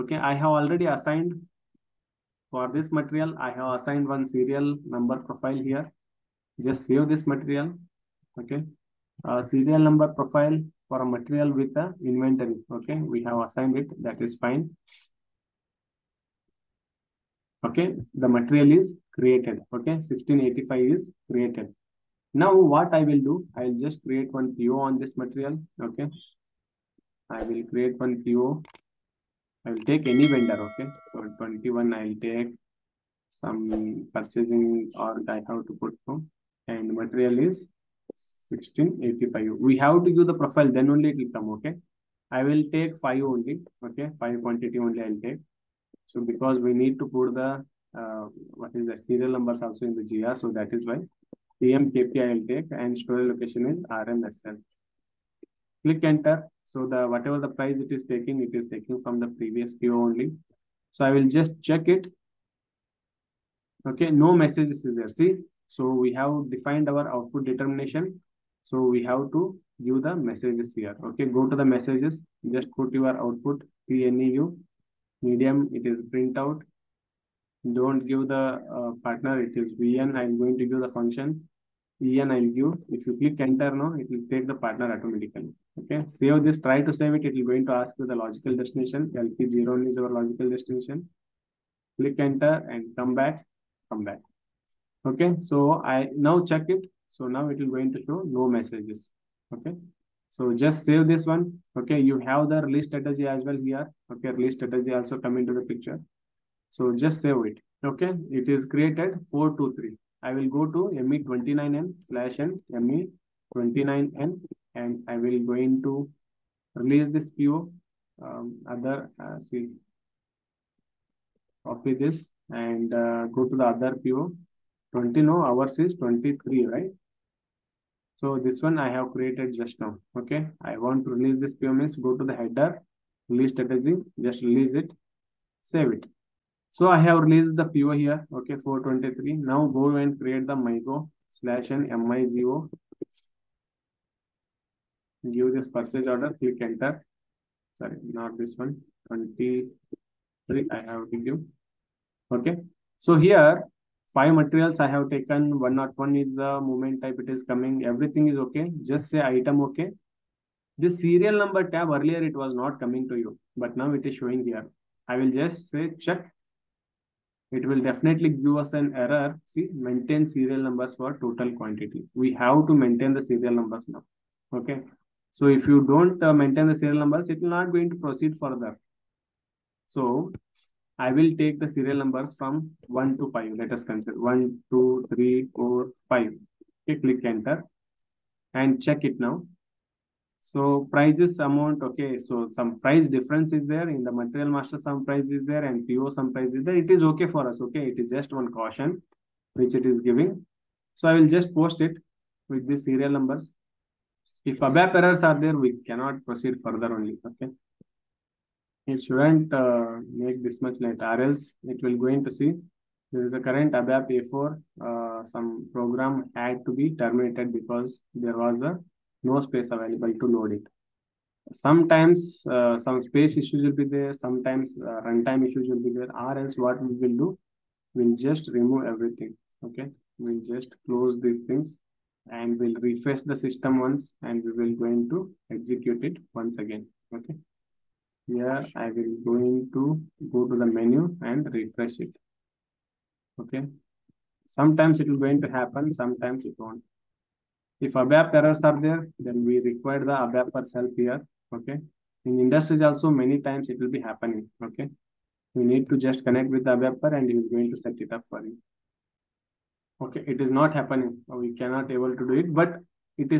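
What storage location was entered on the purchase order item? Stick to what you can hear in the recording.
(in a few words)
RMSL.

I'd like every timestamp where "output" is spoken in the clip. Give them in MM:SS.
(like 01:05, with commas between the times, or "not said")
01:07, 01:13.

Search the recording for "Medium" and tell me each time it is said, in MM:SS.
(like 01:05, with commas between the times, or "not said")
01:15.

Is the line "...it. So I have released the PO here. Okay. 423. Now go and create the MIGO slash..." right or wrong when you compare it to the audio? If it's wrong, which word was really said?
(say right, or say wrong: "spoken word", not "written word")
right.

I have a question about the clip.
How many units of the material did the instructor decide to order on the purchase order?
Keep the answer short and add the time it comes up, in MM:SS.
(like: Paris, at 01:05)
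5, at 00:42.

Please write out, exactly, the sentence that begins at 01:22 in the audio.
If you click enter now, it will take the partner automatically.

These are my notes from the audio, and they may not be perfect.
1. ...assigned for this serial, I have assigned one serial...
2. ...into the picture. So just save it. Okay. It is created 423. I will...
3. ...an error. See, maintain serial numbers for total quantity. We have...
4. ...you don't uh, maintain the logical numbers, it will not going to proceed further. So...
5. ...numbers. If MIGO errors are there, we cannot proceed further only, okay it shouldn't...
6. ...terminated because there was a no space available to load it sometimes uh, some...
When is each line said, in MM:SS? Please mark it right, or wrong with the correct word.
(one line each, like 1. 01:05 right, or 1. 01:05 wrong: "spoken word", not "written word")
1. 00:00 wrong: "material", not "serial"
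2. 01:45 right
3. 02:48 right
4. 02:55 wrong: "serial", not "logical"
5. 03:23 wrong: "ABAP", not "MIGO"
6. 03:36 right.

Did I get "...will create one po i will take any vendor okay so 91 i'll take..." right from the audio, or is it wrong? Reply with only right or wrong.
wrong.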